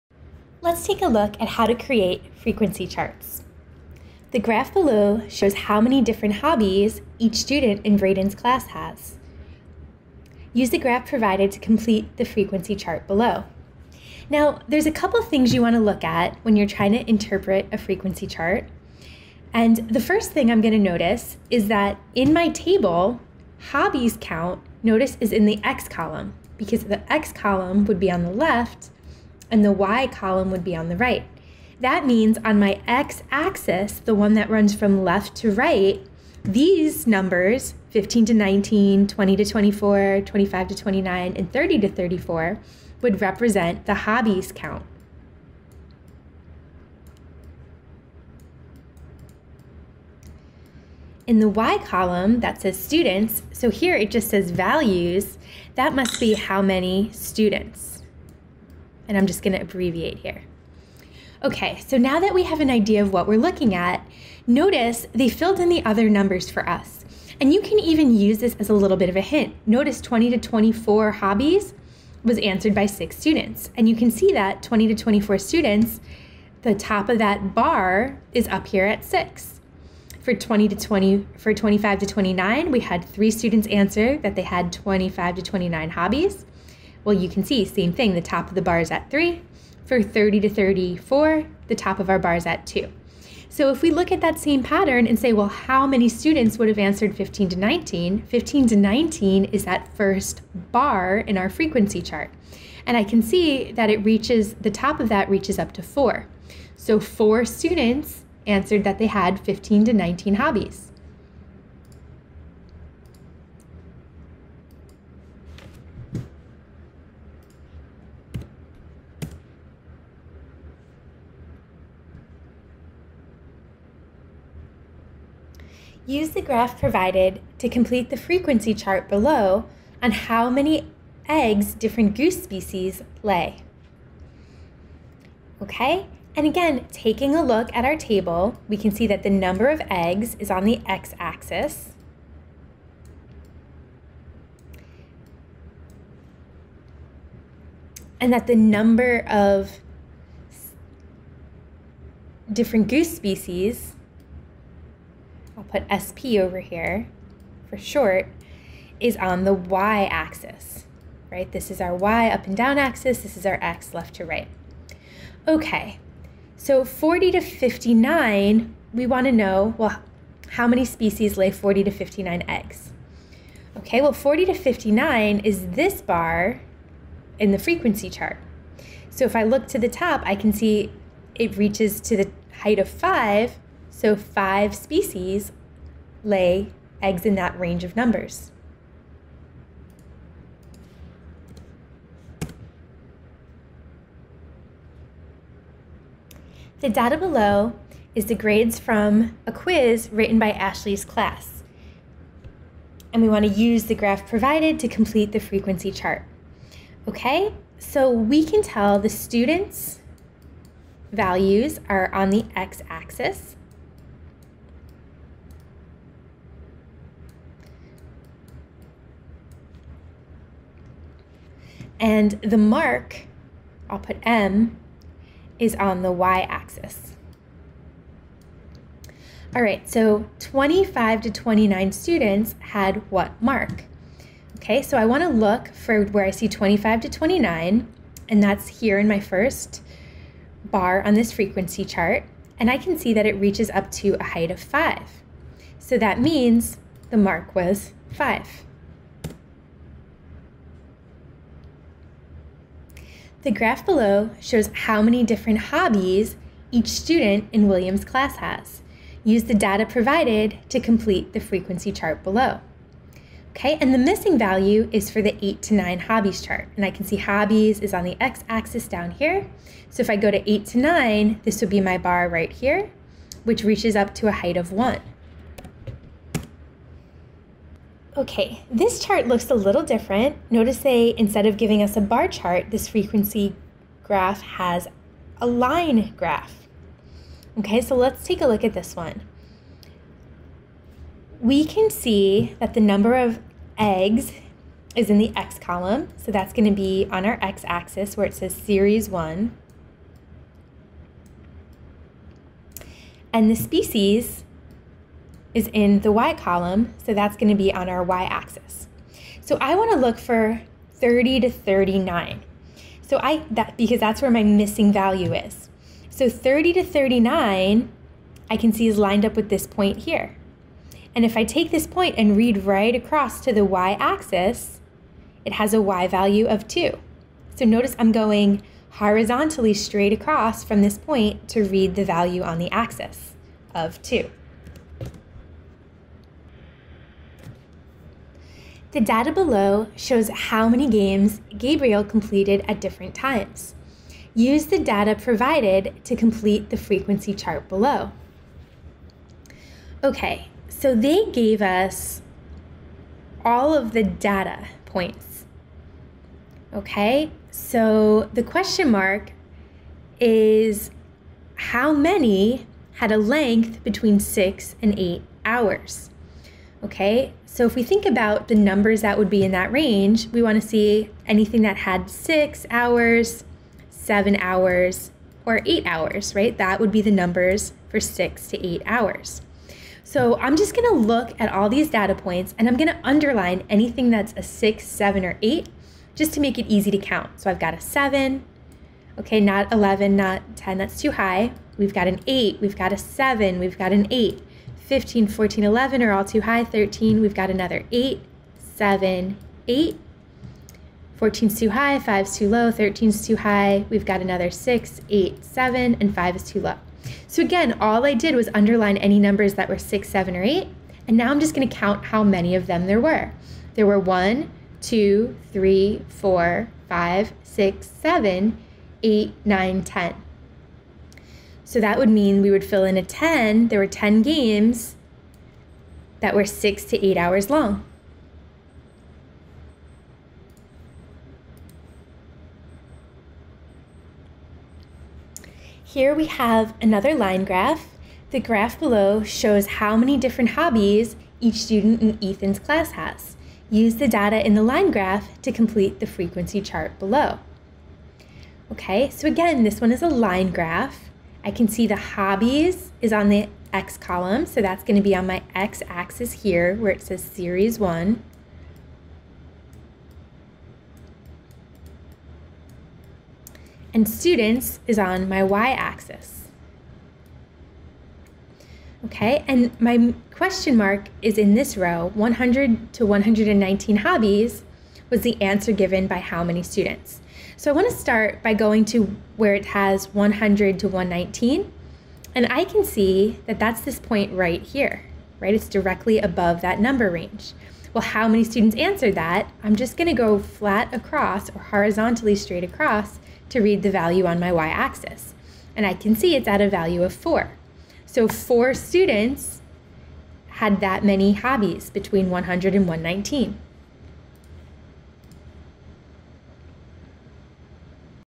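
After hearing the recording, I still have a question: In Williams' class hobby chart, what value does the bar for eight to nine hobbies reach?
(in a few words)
1.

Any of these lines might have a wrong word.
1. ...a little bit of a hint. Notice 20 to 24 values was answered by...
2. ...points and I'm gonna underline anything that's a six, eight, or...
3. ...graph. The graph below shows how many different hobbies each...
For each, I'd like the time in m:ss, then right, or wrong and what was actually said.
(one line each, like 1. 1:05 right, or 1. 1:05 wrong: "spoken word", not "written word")
1. 1:08 wrong: "hobbies", not "values"
2. 6:22 wrong: "seven", not "eight"
3. 7:17 right.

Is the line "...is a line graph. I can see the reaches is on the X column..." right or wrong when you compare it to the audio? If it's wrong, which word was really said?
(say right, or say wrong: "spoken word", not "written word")
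wrong: "hobbies", not "reaches".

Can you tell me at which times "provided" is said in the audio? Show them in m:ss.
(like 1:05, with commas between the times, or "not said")
0:11, 2:06, 3:24, 4:19, 5:45.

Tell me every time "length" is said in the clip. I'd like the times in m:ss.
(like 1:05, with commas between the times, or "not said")
6:03.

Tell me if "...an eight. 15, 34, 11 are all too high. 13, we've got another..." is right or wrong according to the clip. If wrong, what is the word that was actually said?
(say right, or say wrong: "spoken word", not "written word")
wrong: "14", not "34".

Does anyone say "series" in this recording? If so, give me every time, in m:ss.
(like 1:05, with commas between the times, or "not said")
4:58, 7:37.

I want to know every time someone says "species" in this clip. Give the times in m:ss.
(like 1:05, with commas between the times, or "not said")
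2:12, 2:33, 2:50, 3:04, 5:03.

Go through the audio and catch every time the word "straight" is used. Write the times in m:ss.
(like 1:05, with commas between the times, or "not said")
5:29, 8:12.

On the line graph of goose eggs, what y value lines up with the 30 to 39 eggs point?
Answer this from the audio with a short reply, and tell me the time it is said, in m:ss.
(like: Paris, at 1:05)
2, at 5:25.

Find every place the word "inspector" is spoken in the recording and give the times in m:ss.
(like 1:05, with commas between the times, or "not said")
not said.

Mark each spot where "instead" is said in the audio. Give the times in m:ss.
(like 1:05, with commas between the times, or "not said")
4:41.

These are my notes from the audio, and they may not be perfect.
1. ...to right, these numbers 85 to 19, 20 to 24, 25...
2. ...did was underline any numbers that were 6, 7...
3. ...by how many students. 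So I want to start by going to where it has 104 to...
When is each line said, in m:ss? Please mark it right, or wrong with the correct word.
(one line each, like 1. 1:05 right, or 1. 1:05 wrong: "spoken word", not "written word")
1. 0:35 wrong: "15", not "85"
2. 6:48 right
3. 7:56 wrong: "100", not "104".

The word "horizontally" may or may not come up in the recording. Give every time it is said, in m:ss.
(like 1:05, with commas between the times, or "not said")
5:28, 8:11.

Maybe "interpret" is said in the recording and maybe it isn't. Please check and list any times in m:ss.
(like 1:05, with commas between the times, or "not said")
0:17.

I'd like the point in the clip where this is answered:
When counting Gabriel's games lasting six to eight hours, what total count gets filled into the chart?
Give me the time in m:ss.
7:02.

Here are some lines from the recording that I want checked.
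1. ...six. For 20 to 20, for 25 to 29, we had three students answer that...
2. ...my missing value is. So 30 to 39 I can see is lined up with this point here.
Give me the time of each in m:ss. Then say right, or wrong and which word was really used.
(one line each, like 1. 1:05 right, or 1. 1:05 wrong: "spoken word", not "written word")
1. 1:19 right
2. 5:14 right.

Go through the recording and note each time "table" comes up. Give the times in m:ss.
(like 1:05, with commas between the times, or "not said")
0:22, 2:17.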